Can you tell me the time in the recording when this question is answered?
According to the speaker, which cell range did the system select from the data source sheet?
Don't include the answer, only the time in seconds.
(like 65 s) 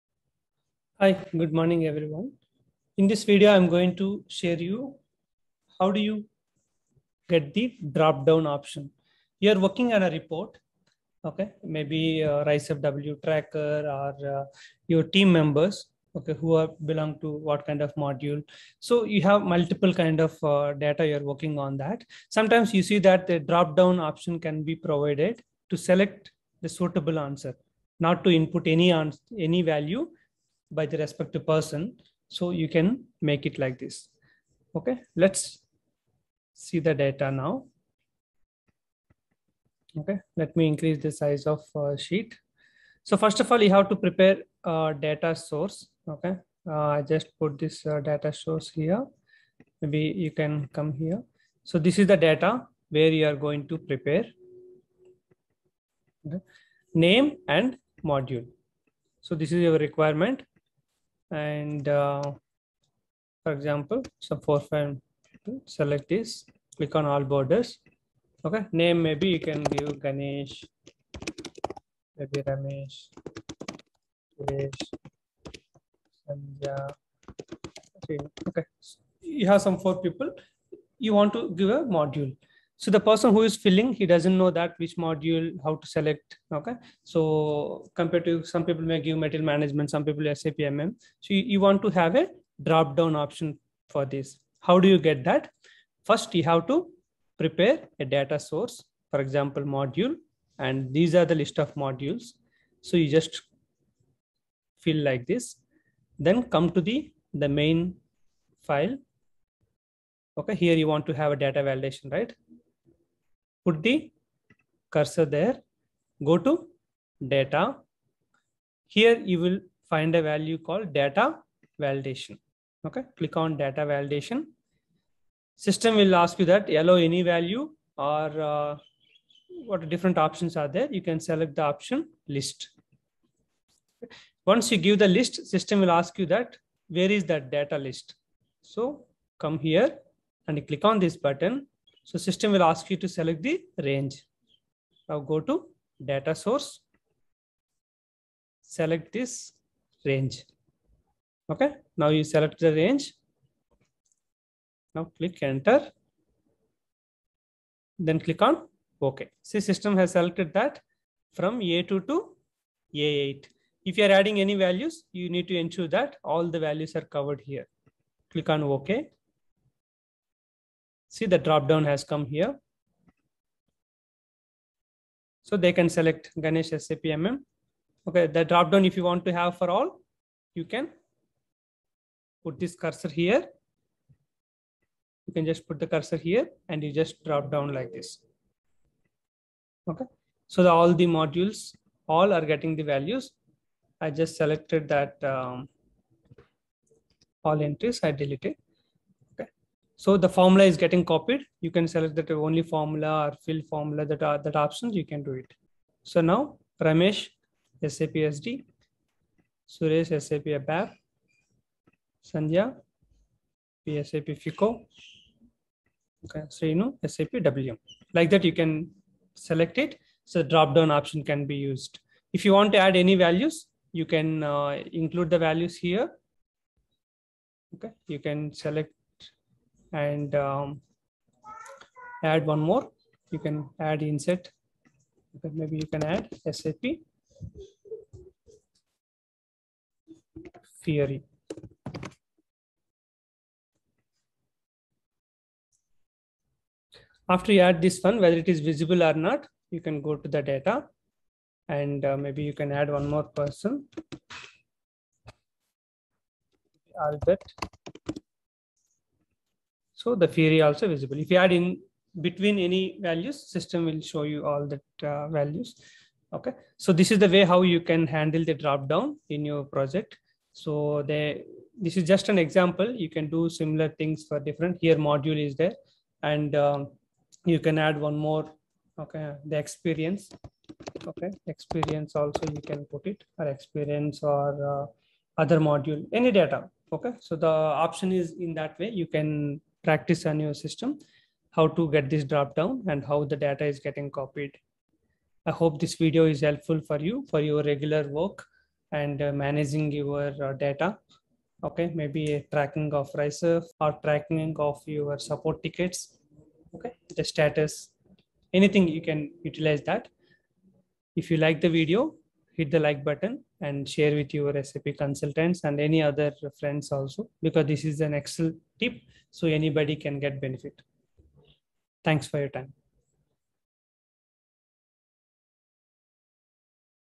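161 s.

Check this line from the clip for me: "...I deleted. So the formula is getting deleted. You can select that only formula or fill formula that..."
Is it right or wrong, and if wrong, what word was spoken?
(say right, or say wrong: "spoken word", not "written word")
wrong: "copied", not "deleted".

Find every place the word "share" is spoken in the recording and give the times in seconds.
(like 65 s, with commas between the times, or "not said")
4 s, 313 s.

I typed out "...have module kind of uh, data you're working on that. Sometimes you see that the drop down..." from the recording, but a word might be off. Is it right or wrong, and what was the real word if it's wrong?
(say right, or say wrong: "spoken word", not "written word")
wrong: "multiple", not "module".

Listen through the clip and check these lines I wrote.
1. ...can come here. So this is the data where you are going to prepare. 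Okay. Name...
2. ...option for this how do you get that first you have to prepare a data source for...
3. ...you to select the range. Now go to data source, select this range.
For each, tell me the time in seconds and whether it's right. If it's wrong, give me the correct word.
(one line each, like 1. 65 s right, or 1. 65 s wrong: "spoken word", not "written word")
1. 50 s right
2. 93 s right
3. 142 s right.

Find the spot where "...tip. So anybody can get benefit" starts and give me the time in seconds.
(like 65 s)
318 s.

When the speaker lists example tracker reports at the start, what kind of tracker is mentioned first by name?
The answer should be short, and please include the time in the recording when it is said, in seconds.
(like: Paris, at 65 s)
RICEW tracker, at 12 s.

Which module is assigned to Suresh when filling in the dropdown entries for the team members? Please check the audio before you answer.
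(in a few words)
SAP ABAP.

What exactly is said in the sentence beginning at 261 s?
If you add in between any values, system will show you all that uh, values.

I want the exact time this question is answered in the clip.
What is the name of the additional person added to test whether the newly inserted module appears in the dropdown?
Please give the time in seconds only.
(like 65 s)
257 s.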